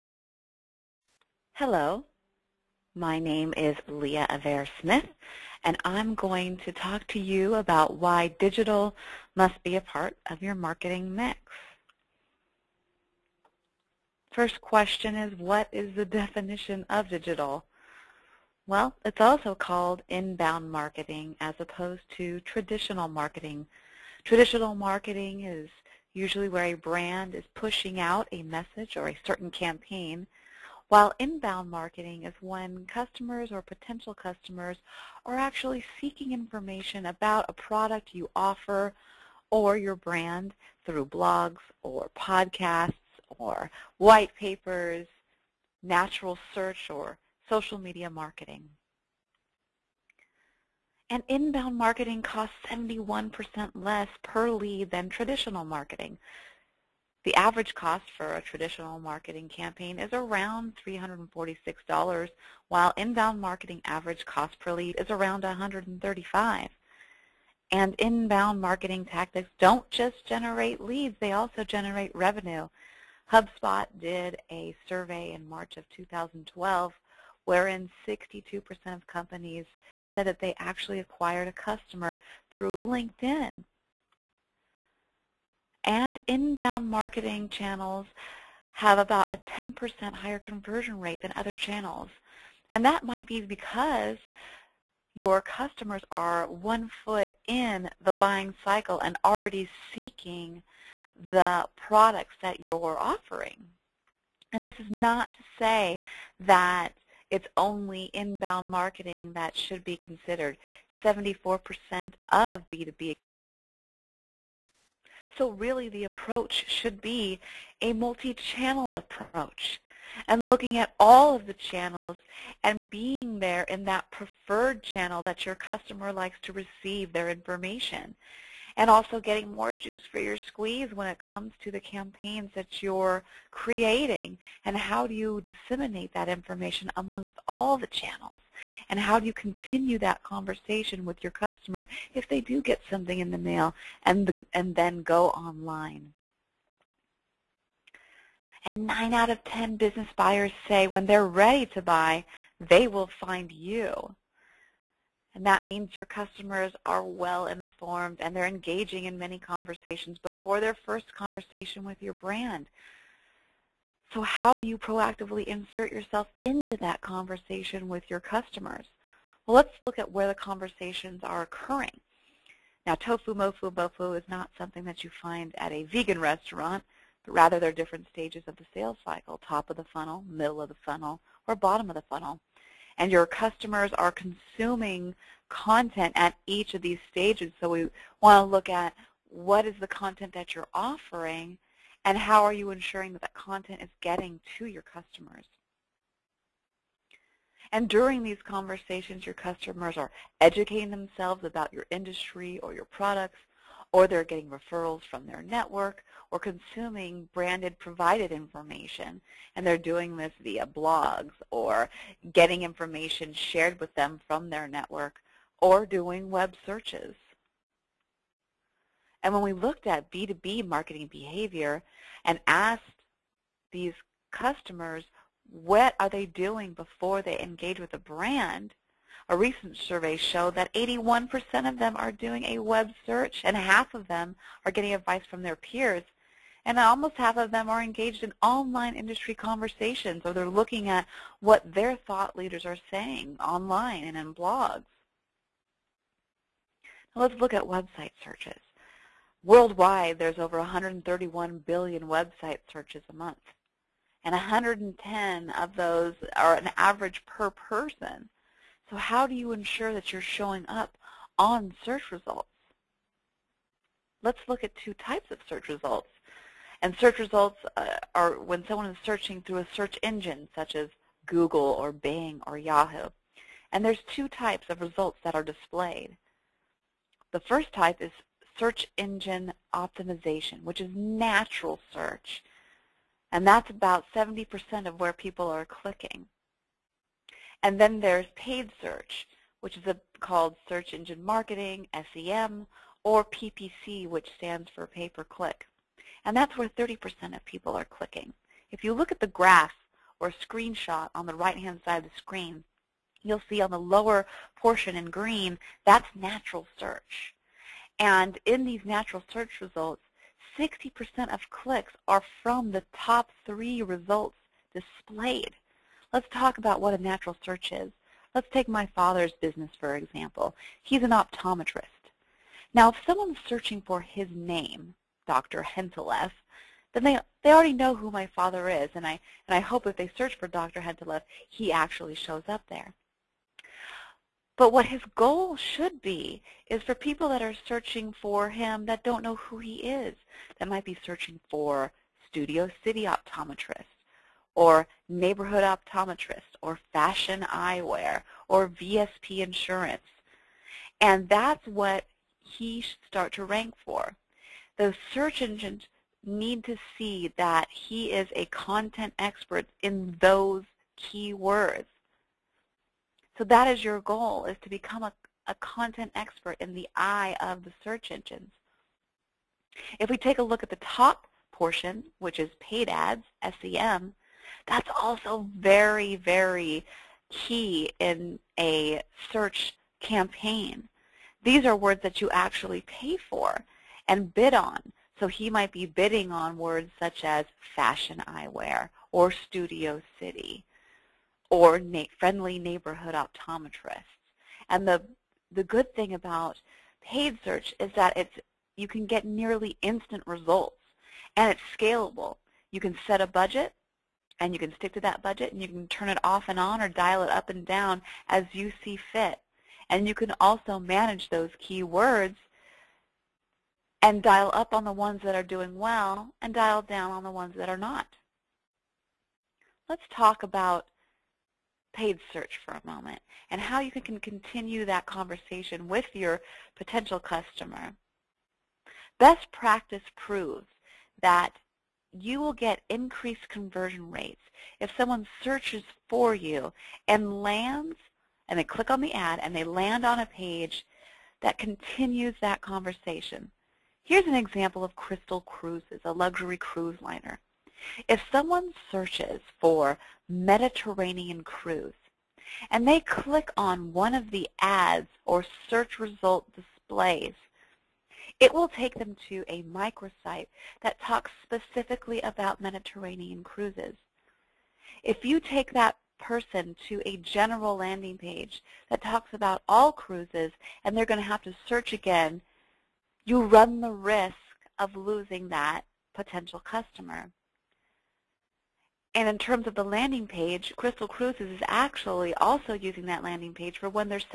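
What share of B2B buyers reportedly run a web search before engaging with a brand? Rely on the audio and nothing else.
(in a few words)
81%.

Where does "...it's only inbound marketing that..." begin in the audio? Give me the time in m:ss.
1:47.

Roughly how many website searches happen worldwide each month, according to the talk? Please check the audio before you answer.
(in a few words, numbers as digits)
131 billion.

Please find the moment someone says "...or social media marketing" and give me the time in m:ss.
0:46.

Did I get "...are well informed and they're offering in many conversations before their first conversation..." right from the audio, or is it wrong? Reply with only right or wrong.
wrong.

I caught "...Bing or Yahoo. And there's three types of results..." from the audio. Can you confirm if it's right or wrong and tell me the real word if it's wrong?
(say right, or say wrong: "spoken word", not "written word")
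wrong: "two", not "three".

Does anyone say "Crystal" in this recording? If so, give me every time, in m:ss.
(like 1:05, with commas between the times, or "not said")
7:24, 8:00.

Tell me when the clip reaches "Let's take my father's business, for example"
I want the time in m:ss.
5:18.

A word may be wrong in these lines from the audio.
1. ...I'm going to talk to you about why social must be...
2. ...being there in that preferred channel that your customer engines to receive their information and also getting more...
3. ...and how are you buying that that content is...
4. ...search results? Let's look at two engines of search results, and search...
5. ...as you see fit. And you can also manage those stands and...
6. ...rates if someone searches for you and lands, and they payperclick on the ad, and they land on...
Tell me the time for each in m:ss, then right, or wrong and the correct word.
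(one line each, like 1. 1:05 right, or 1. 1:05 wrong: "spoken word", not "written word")
1. 0:05 wrong: "digital", not "social"
2. 2:02 wrong: "likes", not "engines"
3. 3:12 wrong: "ensuring", not "buying"
4. 4:21 wrong: "types", not "engines"
5. 6:48 wrong: "keywords", not "stands"
6. 7:14 wrong: "click", not "payperclick".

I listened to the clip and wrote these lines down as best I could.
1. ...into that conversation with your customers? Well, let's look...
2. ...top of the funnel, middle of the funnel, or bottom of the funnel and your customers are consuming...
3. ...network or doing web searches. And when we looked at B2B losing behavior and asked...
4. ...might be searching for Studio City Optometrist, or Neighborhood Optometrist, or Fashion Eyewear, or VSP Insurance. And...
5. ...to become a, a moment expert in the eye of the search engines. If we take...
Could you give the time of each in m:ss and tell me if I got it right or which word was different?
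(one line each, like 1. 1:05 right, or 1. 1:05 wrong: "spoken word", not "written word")
1. 2:46 right
2. 2:59 right
3. 3:34 wrong: "marketing", not "losing"
4. 5:40 right
5. 6:04 wrong: "content", not "moment".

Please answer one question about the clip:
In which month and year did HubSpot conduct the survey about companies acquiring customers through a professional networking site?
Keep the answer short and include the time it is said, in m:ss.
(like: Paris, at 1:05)
March 2012, at 1:15.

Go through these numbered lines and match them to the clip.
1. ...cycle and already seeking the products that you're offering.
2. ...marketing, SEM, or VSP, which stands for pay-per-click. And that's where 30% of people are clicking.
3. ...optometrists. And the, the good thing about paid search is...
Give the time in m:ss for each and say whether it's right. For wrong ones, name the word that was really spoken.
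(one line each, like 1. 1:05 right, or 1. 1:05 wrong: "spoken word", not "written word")
1. 1:38 right
2. 4:51 wrong: "PPC", not "VSP"
3. 6:33 right.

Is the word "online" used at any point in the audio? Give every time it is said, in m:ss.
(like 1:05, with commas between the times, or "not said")
2:25, 3:58, 4:03.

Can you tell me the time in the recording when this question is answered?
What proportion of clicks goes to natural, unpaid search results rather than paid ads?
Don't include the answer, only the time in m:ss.
4:44.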